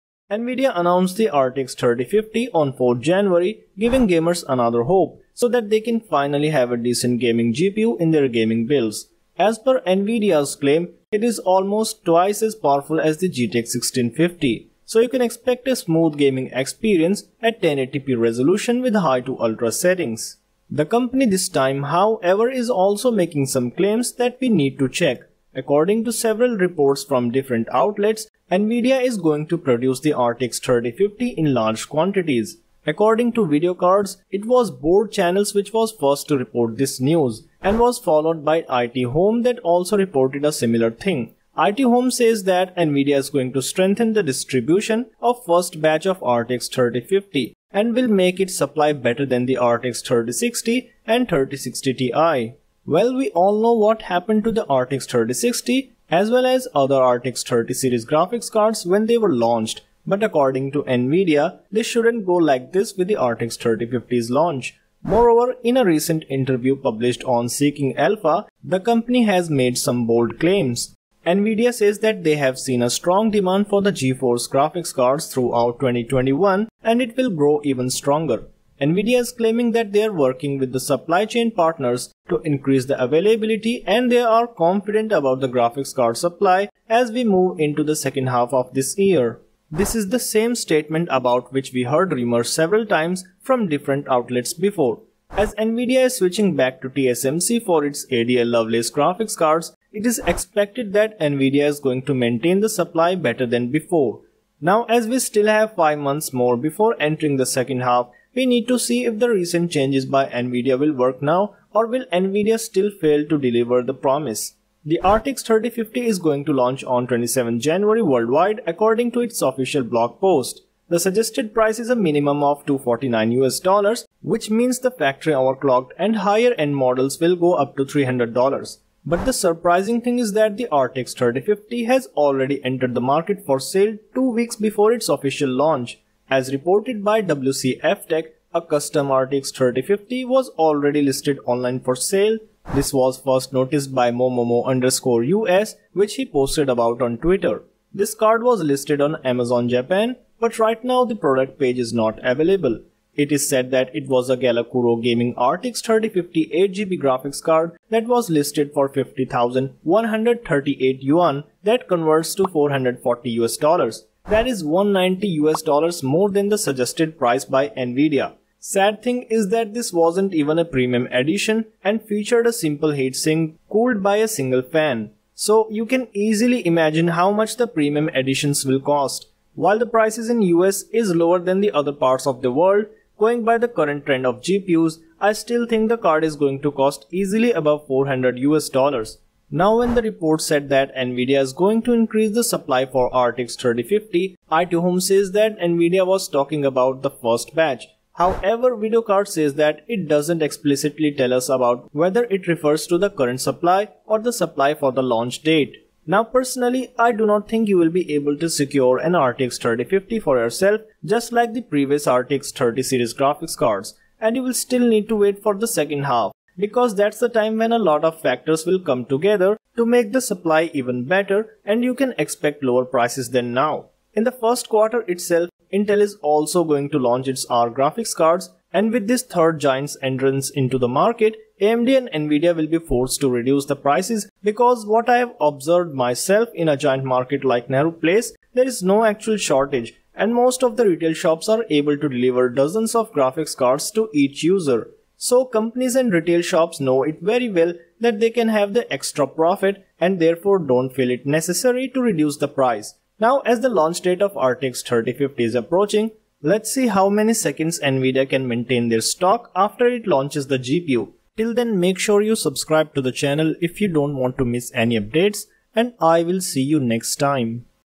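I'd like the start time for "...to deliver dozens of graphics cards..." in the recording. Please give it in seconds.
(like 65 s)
241 s.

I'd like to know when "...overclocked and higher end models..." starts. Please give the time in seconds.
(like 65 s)
125 s.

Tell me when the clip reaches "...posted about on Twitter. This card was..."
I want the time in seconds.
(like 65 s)
146 s.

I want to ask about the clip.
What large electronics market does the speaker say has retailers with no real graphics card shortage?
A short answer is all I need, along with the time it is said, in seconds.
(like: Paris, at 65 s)
Nehru Place, at 237 s.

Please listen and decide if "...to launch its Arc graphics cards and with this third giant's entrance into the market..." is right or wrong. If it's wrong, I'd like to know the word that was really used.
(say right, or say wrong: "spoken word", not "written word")
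right.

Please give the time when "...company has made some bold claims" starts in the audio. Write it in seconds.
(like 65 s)
68 s.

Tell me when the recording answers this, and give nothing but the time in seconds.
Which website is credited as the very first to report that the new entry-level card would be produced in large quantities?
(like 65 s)
34 s.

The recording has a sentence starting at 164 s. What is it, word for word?
That is 190 US dollars more than the suggested price by Nvidia.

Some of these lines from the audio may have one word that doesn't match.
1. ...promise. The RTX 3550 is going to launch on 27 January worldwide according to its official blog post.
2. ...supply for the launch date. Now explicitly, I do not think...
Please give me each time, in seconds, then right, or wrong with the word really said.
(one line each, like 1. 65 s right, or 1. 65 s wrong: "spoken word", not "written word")
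1. 113 s wrong: "3050", not "3550"
2. 204 s wrong: "personally", not "explicitly".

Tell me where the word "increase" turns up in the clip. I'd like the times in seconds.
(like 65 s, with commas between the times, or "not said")
82 s, 191 s.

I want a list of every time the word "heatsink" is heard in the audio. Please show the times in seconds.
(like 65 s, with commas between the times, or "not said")
172 s.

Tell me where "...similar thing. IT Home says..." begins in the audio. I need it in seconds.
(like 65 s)
40 s.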